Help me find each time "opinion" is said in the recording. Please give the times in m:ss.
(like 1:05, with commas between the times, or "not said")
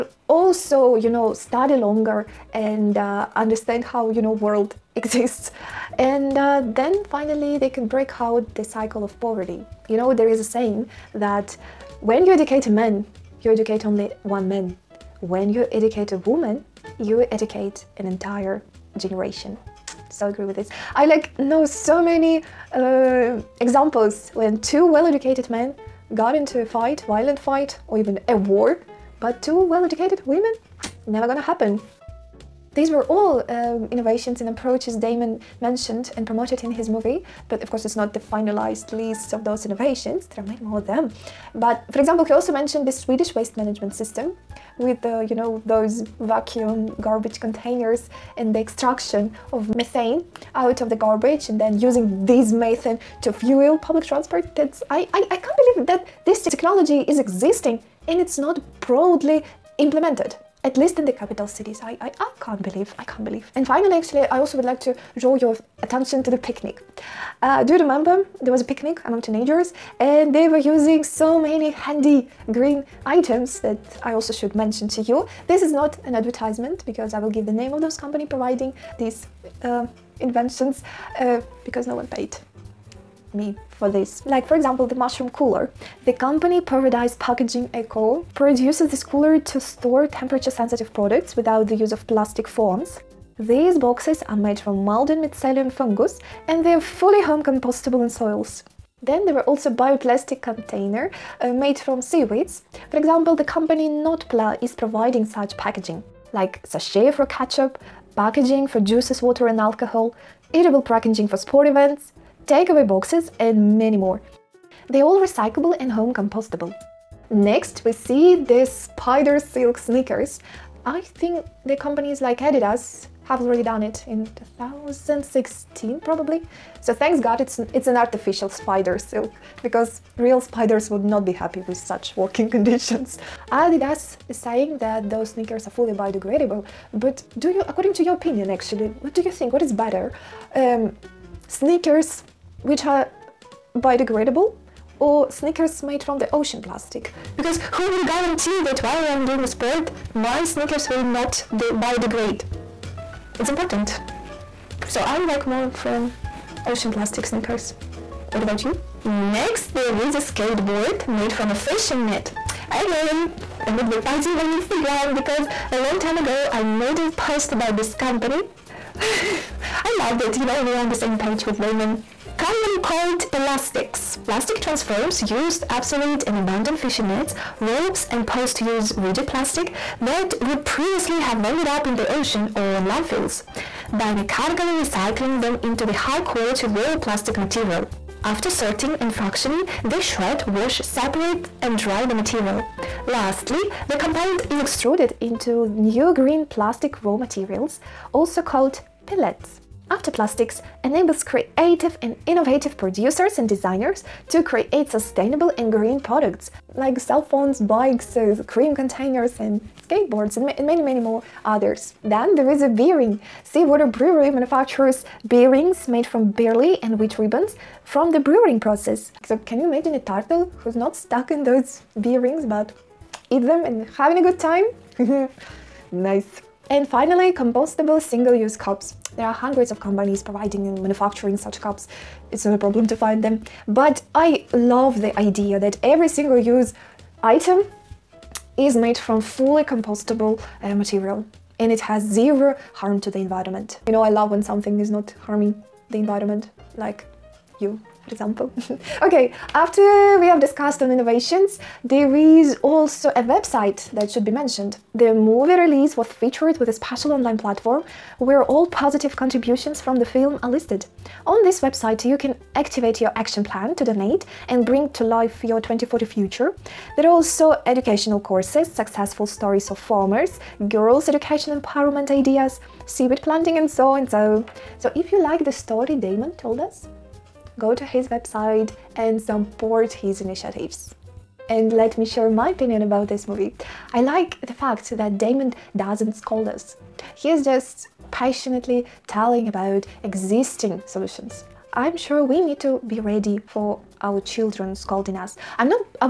2:18, 4:42.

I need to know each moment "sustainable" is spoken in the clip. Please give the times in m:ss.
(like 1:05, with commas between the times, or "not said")
3:24.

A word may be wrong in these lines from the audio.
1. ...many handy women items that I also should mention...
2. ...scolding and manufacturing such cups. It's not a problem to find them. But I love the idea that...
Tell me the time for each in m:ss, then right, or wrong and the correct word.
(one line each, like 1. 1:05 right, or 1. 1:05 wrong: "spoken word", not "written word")
1. 1:11 wrong: "green", not "women"
2. 3:50 wrong: "providing", not "scolding".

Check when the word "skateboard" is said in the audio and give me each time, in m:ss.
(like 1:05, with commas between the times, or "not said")
2:40, 3:29.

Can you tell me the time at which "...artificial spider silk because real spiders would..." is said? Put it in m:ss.
2:07.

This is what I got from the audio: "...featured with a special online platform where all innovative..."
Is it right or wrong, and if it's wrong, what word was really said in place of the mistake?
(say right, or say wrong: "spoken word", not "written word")
wrong: "positive", not "innovative".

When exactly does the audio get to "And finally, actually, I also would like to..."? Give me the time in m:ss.
1:03.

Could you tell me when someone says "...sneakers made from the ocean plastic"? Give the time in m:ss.
2:25.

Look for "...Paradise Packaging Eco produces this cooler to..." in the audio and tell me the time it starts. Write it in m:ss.
1:26.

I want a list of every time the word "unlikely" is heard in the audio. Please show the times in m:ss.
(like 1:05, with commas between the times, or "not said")
not said.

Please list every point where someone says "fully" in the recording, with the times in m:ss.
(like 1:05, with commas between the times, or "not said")
1:36, 2:15, 3:59.